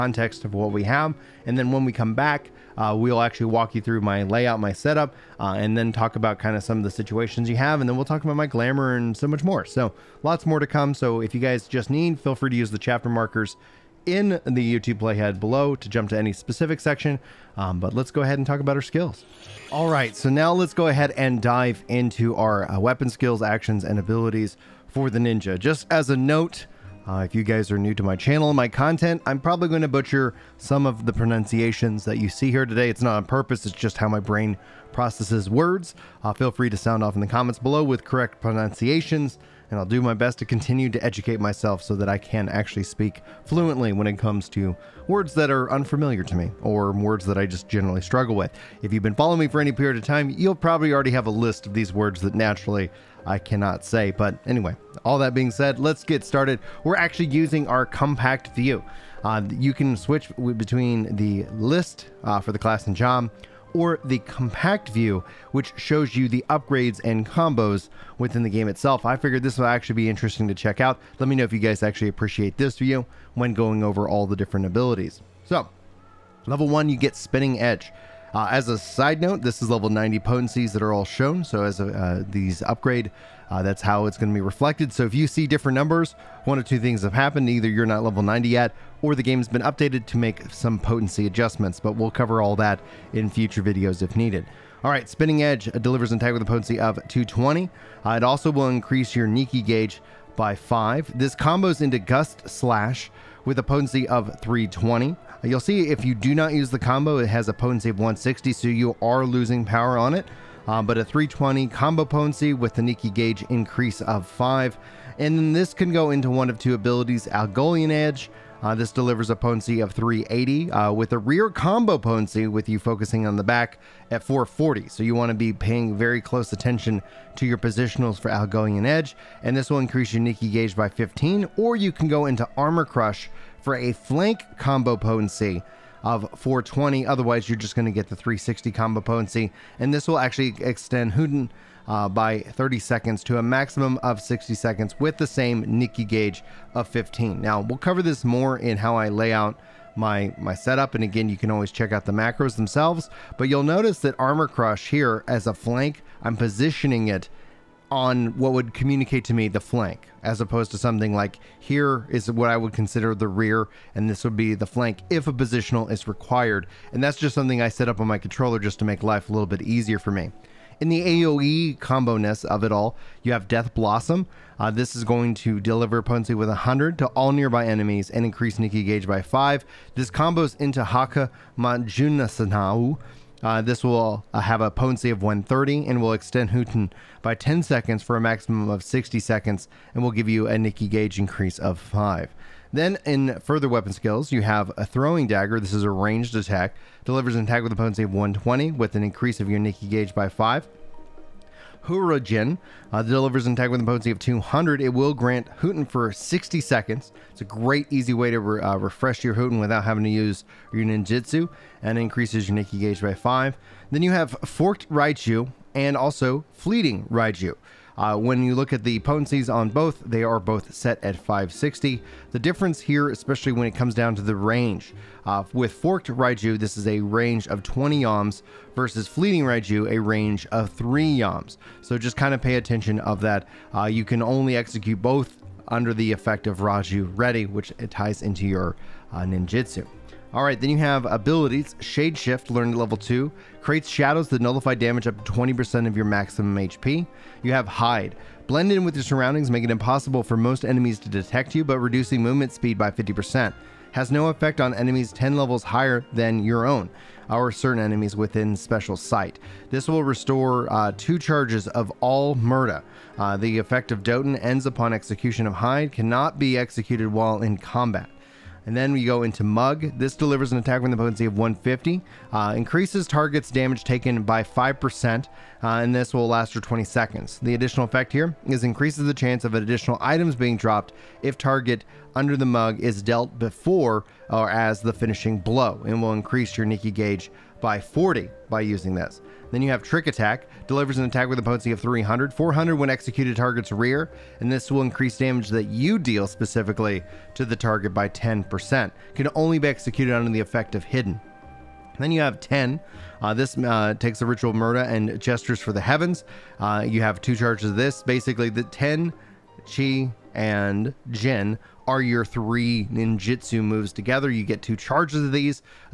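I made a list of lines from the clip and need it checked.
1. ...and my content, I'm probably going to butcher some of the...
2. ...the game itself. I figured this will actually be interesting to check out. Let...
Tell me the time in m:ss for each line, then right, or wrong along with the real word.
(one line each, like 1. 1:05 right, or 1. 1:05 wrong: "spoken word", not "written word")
1. 0:28 right
2. 1:08 right.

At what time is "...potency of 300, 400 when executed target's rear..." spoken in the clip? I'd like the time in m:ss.
4:51.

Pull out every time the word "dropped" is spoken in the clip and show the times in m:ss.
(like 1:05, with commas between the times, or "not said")
4:40.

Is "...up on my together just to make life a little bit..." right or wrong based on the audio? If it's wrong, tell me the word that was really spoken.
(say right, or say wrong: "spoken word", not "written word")
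wrong: "controller", not "together".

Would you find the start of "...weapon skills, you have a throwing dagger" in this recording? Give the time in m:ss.
3:13.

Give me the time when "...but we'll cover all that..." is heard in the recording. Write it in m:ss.
1:31.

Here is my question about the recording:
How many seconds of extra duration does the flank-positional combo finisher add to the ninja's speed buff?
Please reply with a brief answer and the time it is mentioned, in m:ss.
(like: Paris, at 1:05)
30 seconds, at 2:22.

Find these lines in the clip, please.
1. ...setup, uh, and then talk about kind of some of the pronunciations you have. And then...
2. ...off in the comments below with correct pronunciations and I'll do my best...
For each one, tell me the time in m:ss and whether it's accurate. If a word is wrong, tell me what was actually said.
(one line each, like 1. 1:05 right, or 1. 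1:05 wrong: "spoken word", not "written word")
1. 0:04 wrong: "situations", not "pronunciations"
2. 0:37 right.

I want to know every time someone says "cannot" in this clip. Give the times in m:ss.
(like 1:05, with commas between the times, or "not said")
0:53, 4:25.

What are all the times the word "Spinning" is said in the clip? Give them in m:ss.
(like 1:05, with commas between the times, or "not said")
1:17, 1:35.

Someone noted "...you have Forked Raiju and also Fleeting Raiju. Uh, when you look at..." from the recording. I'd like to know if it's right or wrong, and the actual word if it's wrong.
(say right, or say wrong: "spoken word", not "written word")
right.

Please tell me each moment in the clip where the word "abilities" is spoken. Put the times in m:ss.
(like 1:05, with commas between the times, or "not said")
0:23, 1:14, 1:56, 4:01.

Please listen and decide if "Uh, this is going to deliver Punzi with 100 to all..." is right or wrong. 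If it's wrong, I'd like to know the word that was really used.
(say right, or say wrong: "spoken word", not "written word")
right.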